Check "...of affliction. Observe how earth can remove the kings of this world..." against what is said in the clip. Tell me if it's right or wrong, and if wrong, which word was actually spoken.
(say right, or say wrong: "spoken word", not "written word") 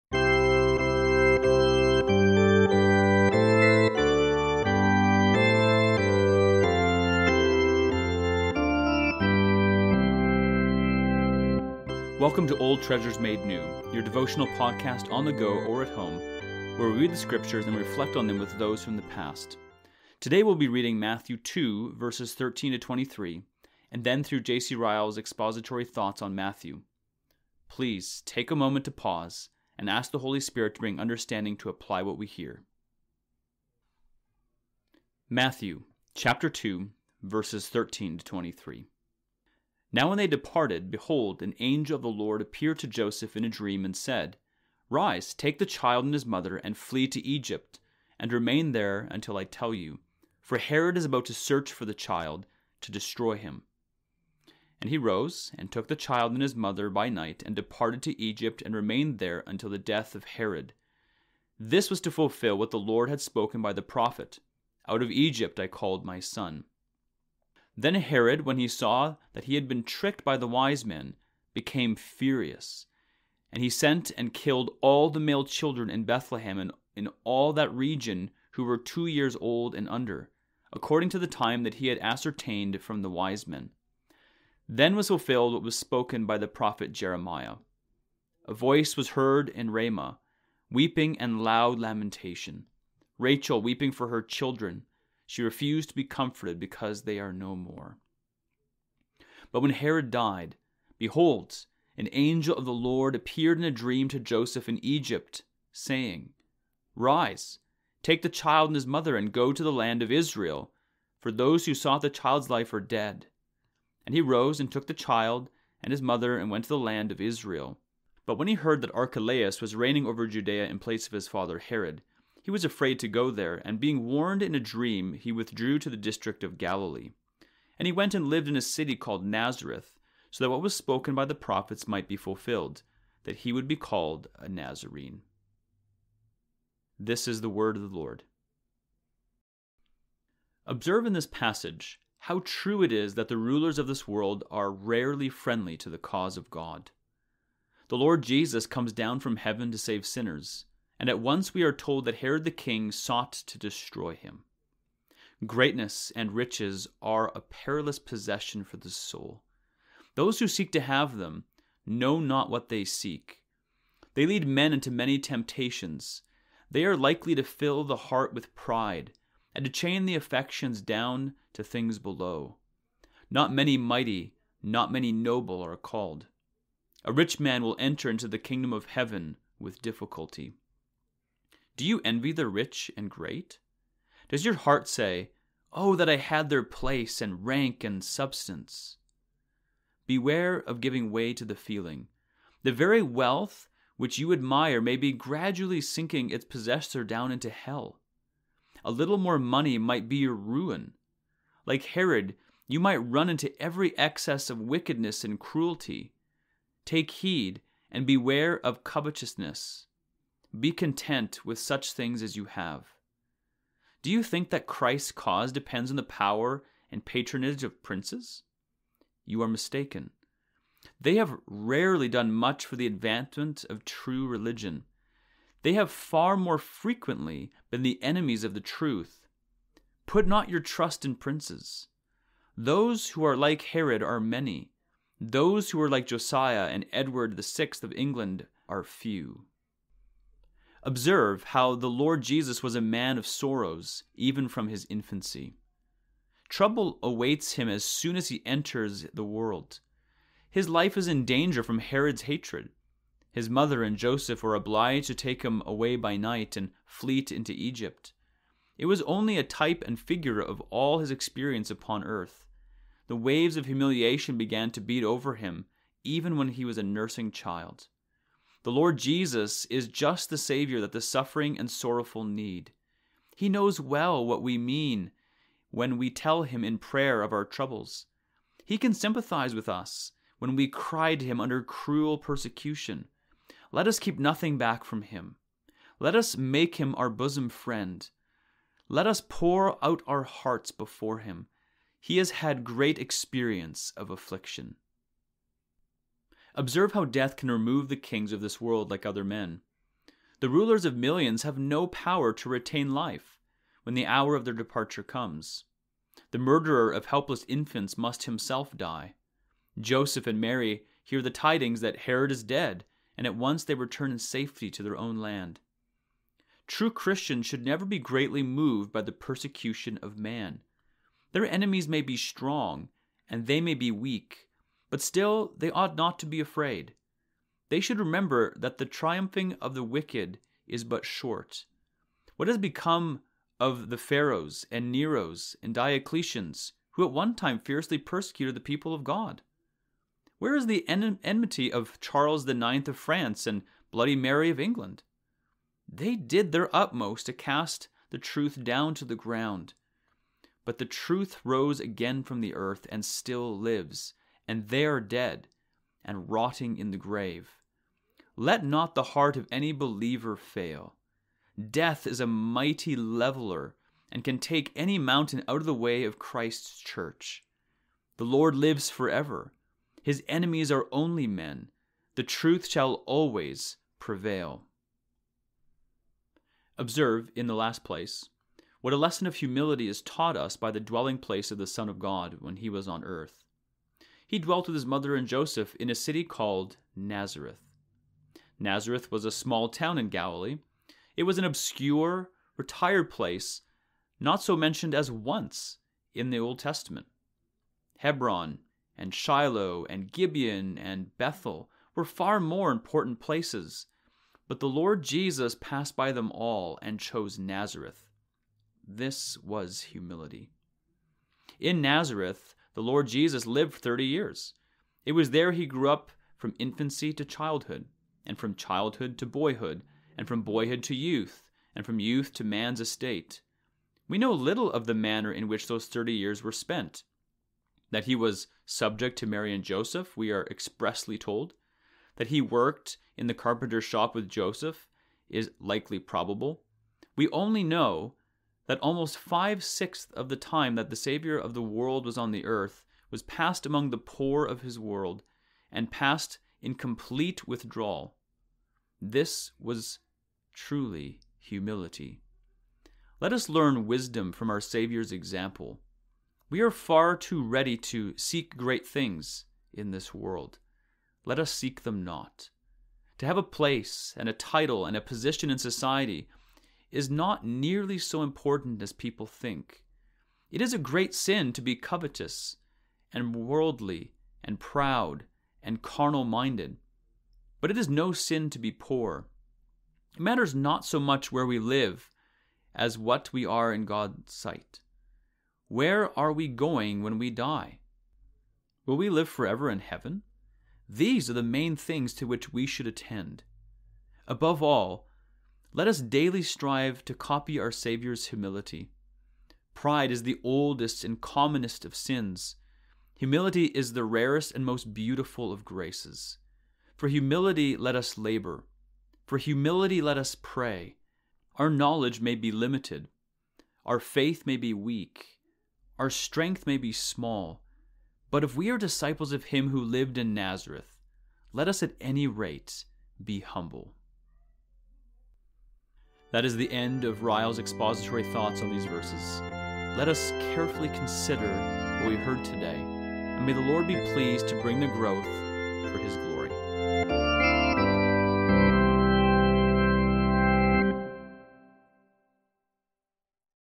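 wrong: "death", not "earth".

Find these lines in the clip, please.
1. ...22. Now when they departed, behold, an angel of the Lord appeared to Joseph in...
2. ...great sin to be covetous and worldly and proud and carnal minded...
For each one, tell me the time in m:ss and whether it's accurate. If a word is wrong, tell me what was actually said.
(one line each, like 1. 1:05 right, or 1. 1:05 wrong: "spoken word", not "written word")
1. 0:38 wrong: "23", not "22"
2. 7:50 right.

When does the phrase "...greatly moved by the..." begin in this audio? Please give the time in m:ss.
5:17.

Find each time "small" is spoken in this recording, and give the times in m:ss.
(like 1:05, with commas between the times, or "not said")
6:29, 8:36.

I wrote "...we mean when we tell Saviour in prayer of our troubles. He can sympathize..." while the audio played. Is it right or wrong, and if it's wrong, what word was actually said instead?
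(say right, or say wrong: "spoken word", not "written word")
wrong: "Him", not "Saviour".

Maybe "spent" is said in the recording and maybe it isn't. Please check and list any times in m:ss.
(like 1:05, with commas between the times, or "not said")
7:06.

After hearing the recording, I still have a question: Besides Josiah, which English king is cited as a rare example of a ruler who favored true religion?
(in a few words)
Edward the Sixth.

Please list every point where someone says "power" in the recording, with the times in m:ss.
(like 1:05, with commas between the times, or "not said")
3:36, 5:01.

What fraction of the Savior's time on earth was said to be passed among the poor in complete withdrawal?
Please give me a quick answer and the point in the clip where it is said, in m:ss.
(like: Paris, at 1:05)
five sixths, at 7:19.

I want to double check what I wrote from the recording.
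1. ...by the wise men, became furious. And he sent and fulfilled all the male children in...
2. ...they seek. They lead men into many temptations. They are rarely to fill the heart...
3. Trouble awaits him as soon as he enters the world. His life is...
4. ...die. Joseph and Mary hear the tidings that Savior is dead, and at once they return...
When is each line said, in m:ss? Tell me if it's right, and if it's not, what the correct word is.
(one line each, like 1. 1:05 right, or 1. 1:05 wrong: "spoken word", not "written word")
1. 1:10 wrong: "killed", not "fulfilled"
2. 2:42 wrong: "likely", not "rarely"
3. 4:06 right
4. 5:08 wrong: "Herod", not "Savior".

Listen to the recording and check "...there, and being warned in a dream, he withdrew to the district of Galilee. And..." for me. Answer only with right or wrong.
right.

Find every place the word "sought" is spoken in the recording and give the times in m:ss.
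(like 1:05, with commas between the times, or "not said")
1:51, 2:32.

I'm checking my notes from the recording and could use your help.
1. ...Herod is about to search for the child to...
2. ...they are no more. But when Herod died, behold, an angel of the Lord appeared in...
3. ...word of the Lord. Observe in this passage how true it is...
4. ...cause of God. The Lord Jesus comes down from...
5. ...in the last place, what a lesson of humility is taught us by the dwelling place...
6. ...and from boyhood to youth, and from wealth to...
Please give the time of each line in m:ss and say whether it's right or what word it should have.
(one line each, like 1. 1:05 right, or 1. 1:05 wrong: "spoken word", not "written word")
1. 0:50 right
2. 1:37 right
3. 2:17 right
4. 2:25 right
5. 6:17 right
6. 7:00 wrong: "youth", not "wealth".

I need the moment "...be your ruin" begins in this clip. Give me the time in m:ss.
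3:20.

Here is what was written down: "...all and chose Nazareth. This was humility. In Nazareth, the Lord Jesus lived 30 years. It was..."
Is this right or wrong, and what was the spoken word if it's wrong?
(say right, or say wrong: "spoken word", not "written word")
right.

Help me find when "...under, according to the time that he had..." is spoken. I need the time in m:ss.
1:19.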